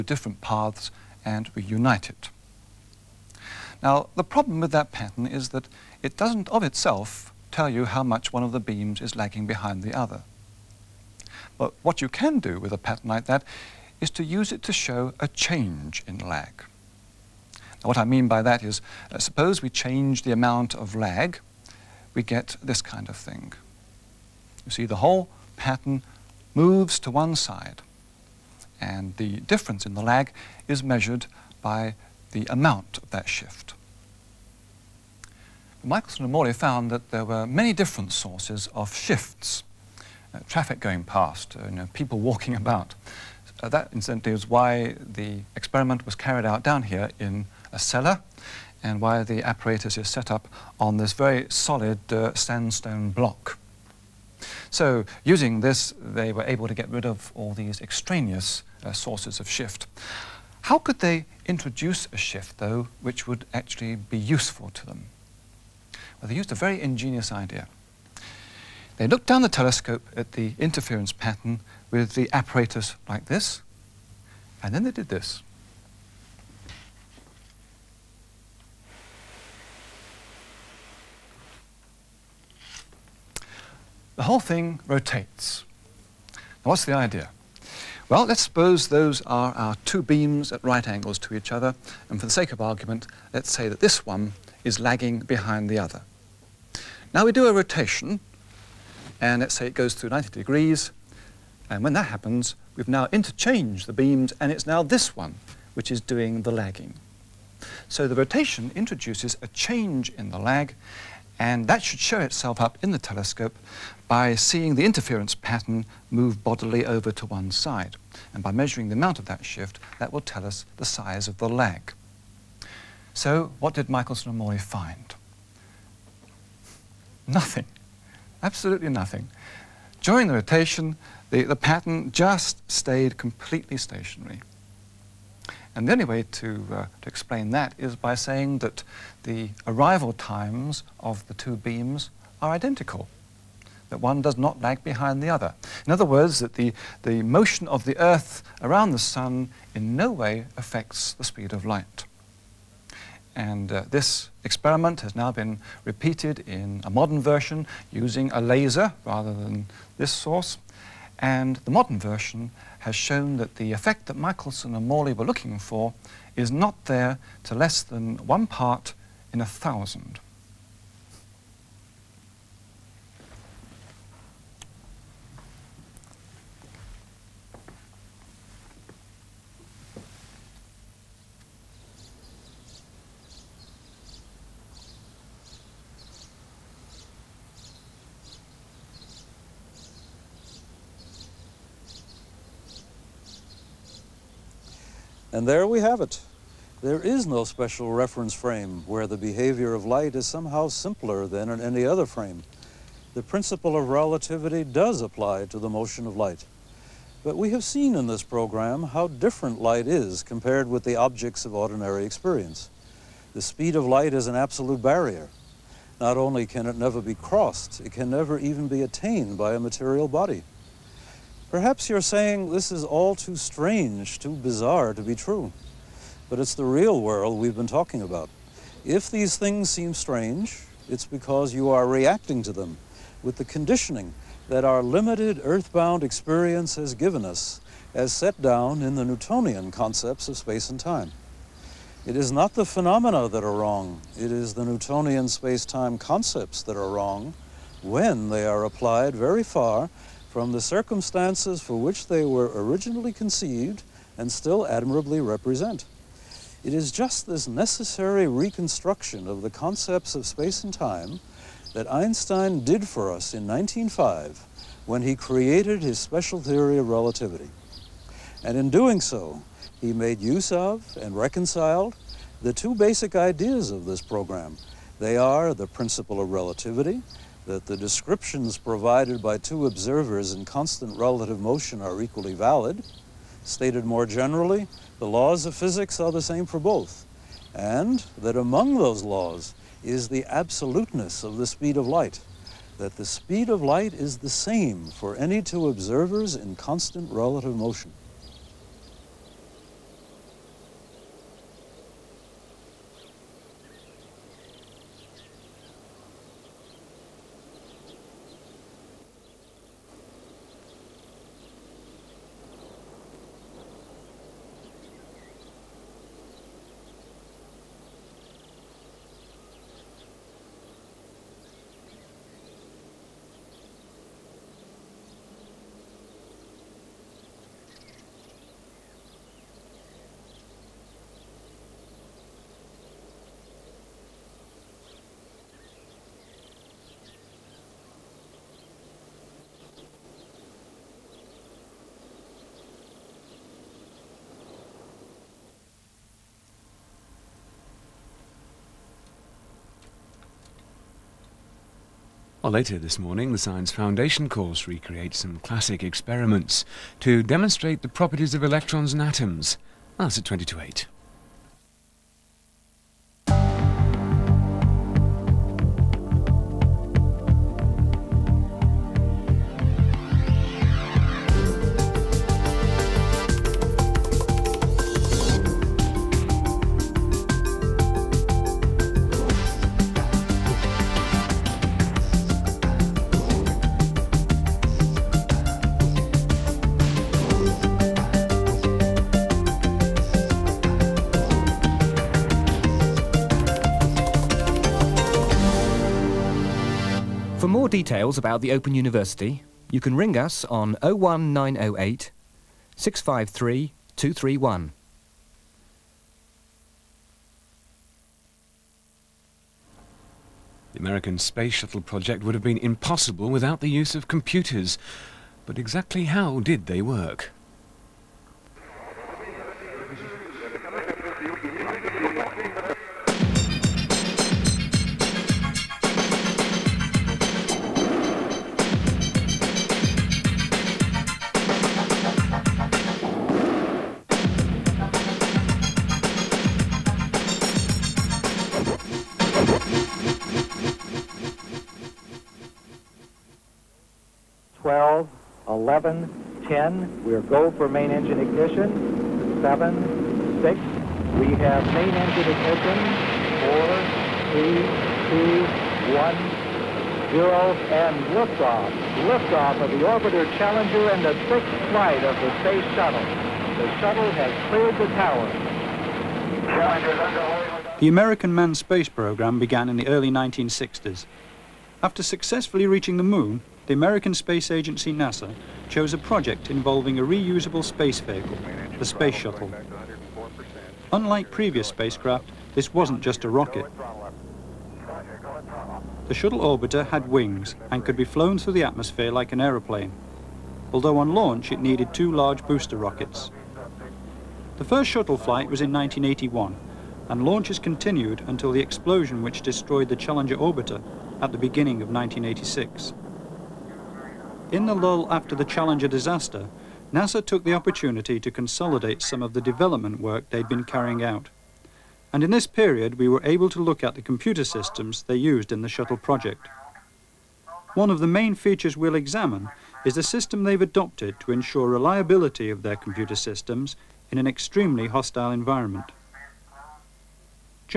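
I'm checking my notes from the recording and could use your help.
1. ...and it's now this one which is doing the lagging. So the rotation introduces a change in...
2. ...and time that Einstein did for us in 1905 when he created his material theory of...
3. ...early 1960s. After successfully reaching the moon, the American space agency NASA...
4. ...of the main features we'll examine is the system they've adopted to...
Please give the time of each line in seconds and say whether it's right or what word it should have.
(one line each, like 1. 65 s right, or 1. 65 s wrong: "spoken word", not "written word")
1. 104 s right
2. 260 s wrong: "special", not "material"
3. 469 s right
4. 517 s right.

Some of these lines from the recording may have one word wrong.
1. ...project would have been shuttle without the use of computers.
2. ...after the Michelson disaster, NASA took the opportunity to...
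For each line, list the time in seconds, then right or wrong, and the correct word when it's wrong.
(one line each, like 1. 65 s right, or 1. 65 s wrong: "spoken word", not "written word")
1. 411 s wrong: "impossible", not "shuttle"
2. 505 s wrong: "Challenger", not "Michelson".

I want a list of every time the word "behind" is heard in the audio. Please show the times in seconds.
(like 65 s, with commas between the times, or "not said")
9 s, 95 s, 144 s.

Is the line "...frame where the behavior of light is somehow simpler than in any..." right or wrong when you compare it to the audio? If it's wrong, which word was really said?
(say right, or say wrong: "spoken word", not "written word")
right.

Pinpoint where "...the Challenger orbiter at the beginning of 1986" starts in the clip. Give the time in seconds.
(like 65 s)
499 s.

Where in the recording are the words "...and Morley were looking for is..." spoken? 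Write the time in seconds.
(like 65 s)
164 s.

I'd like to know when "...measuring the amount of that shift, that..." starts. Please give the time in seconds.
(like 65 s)
118 s.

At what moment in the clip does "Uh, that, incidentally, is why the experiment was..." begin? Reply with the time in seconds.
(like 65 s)
43 s.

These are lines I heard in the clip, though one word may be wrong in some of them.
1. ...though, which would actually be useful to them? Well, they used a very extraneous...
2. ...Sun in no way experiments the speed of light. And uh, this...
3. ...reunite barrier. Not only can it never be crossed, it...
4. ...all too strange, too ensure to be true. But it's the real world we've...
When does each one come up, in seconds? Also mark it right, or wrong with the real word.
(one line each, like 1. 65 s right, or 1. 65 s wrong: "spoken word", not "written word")
1. 62 s wrong: "ingenious", not "extraneous"
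2. 148 s wrong: "affects", not "experiments"
3. 214 s wrong: "absolute", not "reunite"
4. 222 s wrong: "bizarre", not "ensure".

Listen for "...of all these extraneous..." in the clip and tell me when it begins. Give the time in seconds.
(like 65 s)
57 s.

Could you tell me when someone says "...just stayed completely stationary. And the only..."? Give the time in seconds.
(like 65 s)
132 s.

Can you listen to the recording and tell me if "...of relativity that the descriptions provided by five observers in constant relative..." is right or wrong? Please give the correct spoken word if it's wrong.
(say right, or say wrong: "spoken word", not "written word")
wrong: "two", not "five".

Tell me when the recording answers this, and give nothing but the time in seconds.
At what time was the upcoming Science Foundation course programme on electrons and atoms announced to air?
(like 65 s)
360 s.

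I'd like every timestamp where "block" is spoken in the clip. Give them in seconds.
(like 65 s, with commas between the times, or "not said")
53 s.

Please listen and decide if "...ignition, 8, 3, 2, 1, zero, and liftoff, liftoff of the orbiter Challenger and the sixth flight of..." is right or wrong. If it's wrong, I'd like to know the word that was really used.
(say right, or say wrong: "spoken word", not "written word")
wrong: "4", not "8".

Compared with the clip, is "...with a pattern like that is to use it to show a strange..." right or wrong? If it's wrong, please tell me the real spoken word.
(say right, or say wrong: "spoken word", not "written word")
wrong: "change", not "strange".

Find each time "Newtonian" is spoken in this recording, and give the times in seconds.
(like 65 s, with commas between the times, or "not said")
239 s, 244 s.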